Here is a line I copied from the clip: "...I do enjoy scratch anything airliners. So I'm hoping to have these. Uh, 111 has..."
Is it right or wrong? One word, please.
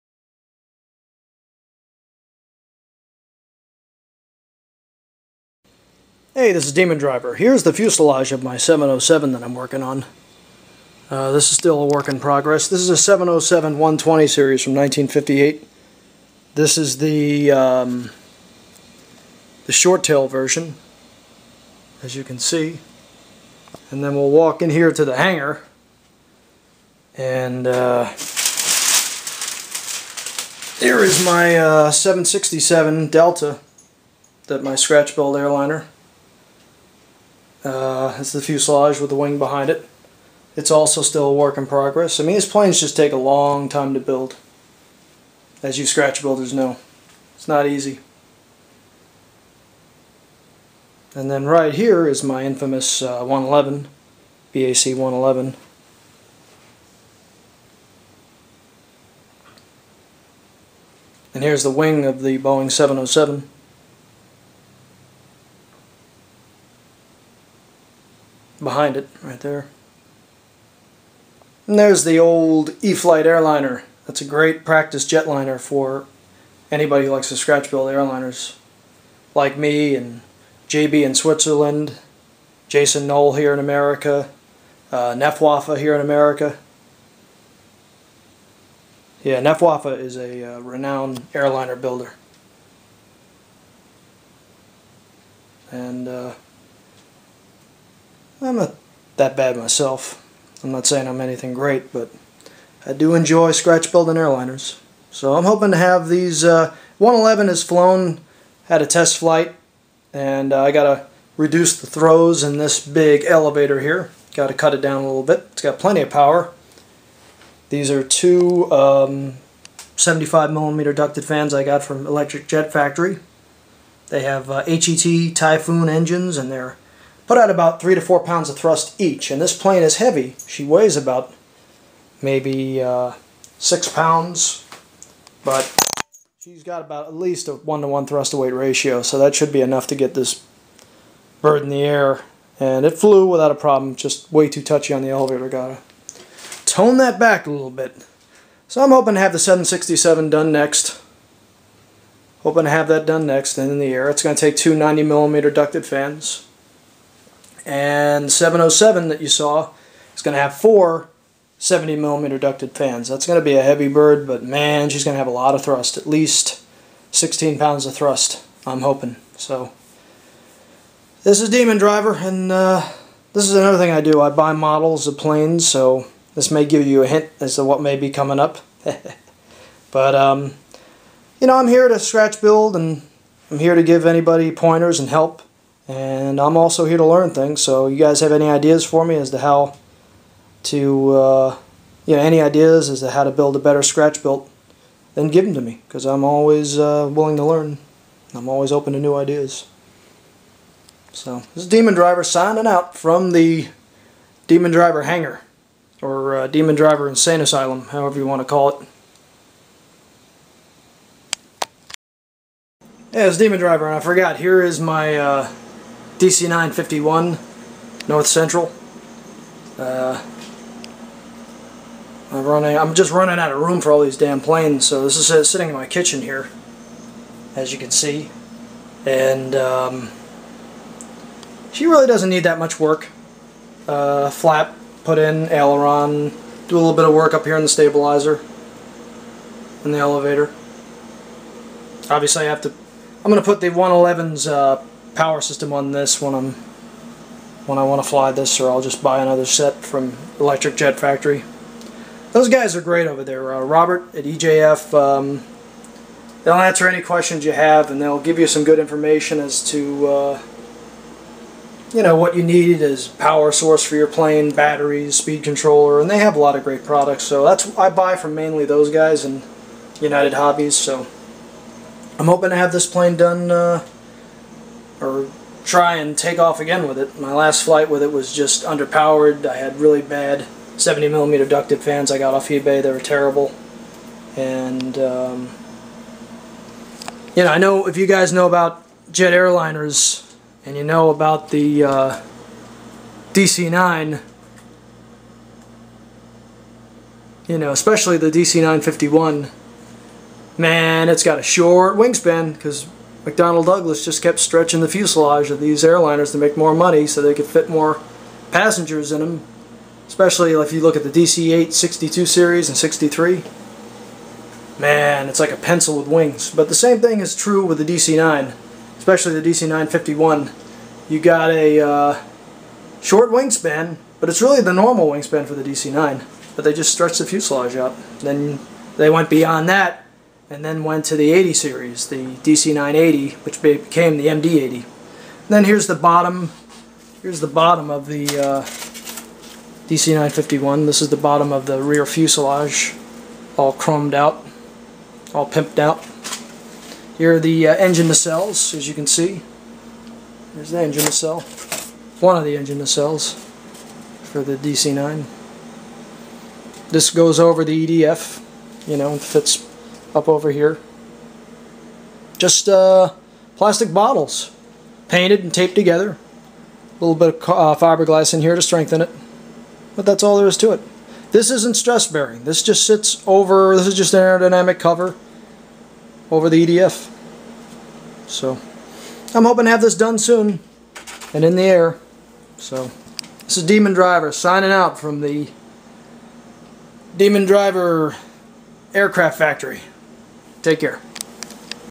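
wrong.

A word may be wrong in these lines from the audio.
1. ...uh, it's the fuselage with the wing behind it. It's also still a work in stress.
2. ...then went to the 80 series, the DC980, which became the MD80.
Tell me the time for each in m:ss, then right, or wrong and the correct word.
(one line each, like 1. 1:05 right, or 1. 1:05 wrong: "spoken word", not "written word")
1. 0:37 wrong: "progress", not "stress"
2. 5:30 right.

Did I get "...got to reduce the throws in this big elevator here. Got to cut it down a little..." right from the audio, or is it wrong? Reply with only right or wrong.
right.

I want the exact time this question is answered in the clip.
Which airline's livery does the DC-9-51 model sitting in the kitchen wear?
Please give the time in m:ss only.
3:38.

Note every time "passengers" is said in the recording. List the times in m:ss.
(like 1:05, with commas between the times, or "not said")
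5:08.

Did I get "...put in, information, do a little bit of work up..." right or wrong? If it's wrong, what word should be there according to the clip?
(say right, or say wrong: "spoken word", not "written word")
wrong: "aileron", not "information".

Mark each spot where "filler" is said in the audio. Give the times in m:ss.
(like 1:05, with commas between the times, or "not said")
not said.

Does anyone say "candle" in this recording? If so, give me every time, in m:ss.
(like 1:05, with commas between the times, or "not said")
not said.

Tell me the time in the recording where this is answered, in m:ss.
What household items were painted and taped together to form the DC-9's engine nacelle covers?
6:03.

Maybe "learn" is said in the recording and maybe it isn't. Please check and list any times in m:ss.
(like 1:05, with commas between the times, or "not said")
3:07, 3:17.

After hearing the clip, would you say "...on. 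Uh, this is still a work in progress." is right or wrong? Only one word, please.
right.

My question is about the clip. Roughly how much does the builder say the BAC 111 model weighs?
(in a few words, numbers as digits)
6 pounds.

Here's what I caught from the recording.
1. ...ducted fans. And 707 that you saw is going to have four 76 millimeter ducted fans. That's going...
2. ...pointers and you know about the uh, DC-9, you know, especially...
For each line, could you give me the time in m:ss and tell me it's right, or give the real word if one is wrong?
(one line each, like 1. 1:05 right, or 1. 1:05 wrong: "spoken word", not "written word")
1. 2:35 wrong: "70", not "76"
2. 4:49 wrong: "airliners", not "pointers".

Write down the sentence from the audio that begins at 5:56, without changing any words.
This goes over the EDF, you know, fits up over here.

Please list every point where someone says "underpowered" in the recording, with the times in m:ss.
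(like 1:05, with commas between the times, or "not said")
4:38.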